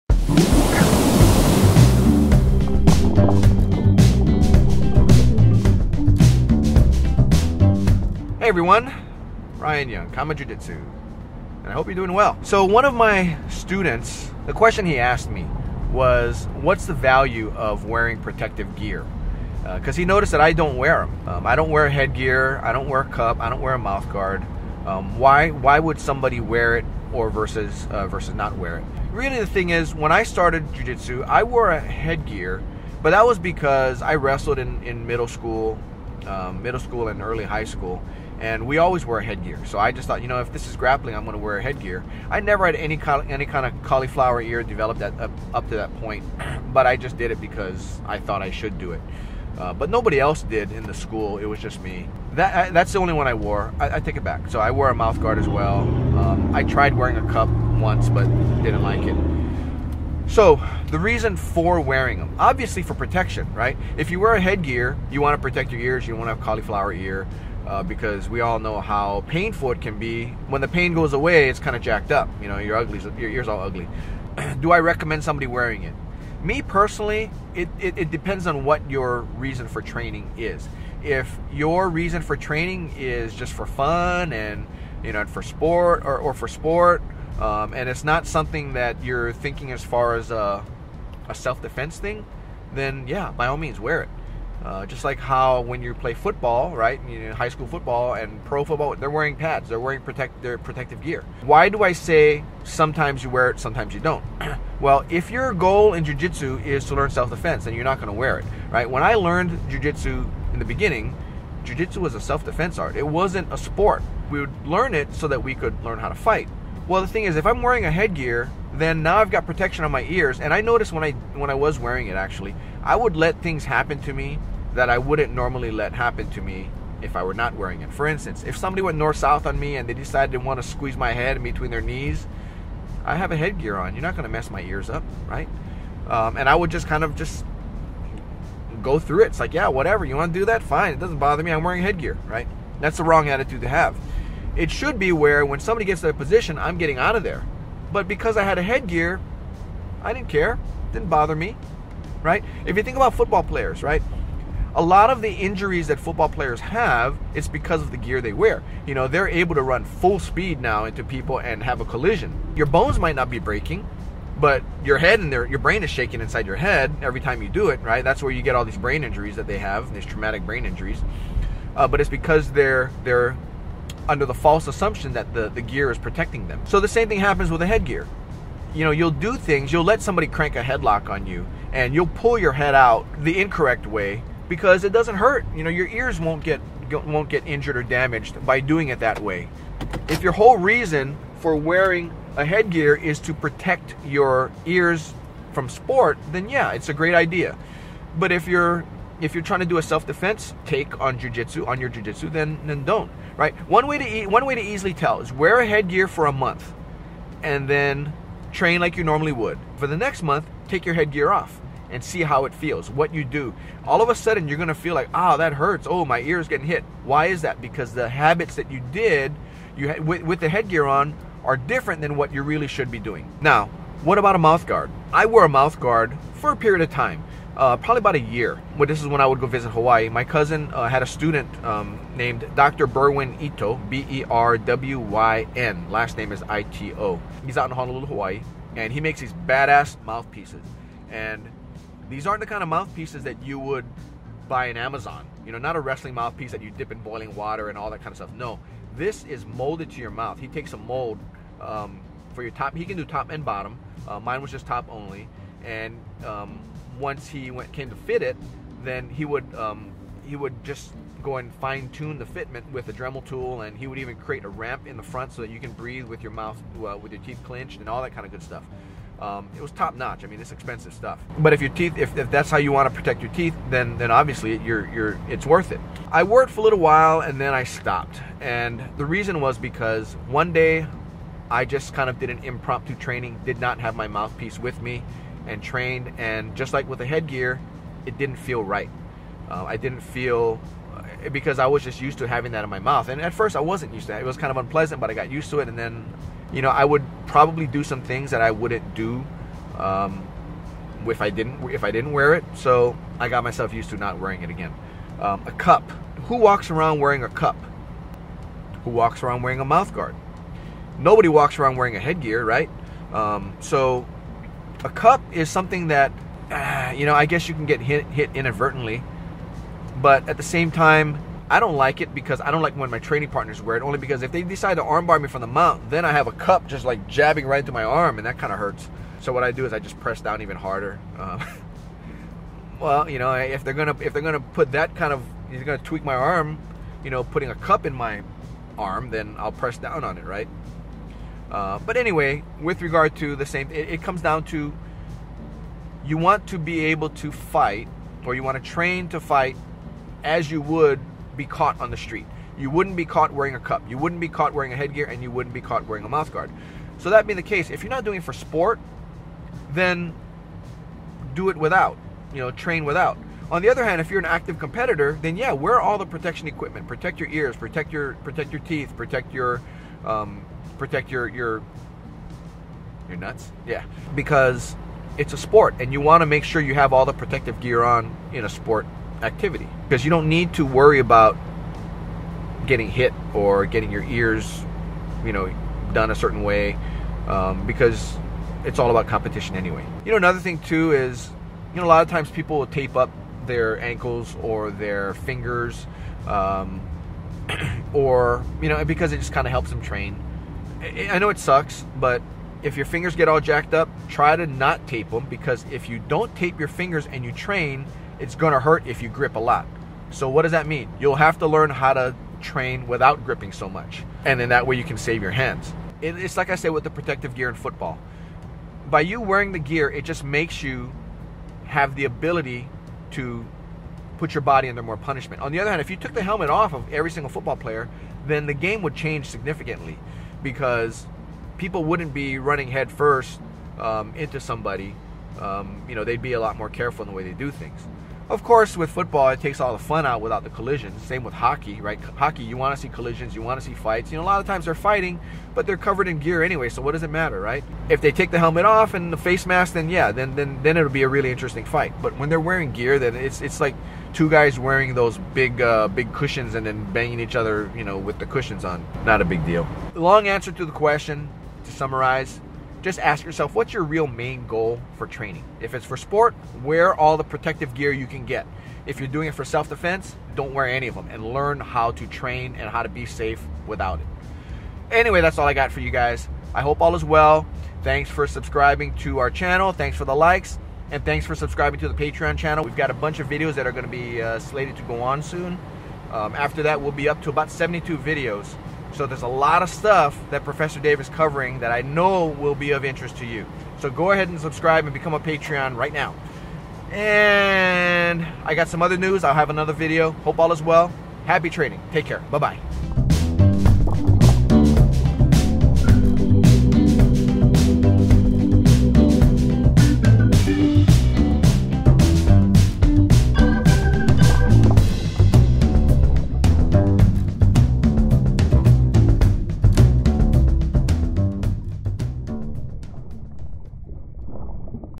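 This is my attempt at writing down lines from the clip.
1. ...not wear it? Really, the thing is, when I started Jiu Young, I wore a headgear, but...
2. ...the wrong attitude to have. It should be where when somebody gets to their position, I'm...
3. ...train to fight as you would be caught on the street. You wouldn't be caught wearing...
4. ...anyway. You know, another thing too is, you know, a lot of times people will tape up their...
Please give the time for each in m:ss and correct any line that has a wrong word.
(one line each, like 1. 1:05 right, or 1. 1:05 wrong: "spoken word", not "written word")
1. 0:28 wrong: "Jitsu", not "Young"
2. 2:22 right
3. 5:48 right
4. 6:29 right.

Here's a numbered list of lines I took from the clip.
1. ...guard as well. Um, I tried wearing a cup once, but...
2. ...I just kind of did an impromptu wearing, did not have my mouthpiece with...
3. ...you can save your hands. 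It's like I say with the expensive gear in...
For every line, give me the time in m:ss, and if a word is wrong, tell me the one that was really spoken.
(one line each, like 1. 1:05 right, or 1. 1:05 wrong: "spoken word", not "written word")
1. 0:55 right
2. 4:41 wrong: "training", not "wearing"
3. 6:54 wrong: "protective", not "expensive".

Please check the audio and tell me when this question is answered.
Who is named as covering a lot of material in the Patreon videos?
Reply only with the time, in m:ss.
8:10.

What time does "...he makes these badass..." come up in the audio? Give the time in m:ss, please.
3:58.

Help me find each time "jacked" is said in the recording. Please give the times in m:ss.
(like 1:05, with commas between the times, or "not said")
1:11, 6:43.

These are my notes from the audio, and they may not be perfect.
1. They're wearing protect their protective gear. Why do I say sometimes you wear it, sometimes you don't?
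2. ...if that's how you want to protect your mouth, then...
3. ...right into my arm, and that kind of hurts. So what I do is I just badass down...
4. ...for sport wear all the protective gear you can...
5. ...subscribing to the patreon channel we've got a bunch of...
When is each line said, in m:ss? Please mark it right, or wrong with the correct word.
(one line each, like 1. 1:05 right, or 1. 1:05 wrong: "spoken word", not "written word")
1. 1:39 right
2. 4:32 wrong: "teeth", not "mouth"
3. 5:27 wrong: "press", not "badass"
4. 7:45 right
5. 8:01 right.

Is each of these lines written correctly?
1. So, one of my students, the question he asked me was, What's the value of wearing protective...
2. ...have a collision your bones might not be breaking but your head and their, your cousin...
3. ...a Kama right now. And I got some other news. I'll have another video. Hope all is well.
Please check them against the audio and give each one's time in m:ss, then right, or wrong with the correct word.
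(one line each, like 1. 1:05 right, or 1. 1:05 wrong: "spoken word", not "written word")
1. 0:12 right
2. 2:41 wrong: "brain", not "cousin"
3. 8:15 wrong: "Patreon", not "Kama".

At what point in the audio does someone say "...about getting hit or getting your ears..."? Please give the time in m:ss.
6:20.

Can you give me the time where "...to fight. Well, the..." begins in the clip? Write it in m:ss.
1:56.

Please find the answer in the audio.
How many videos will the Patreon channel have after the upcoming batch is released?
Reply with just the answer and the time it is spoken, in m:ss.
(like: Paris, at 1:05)
72, at 8:07.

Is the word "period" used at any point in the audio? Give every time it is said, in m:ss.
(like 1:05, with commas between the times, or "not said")
3:46.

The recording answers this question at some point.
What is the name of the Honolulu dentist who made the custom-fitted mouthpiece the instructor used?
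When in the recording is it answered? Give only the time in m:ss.
3:52.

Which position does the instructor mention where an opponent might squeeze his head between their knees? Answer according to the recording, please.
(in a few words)
North south.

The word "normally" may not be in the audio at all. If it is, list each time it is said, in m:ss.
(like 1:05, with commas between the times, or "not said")
2:05, 3:29.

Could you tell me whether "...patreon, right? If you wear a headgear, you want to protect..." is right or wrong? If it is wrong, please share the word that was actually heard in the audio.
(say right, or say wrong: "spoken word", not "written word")
wrong: "protection", not "patreon".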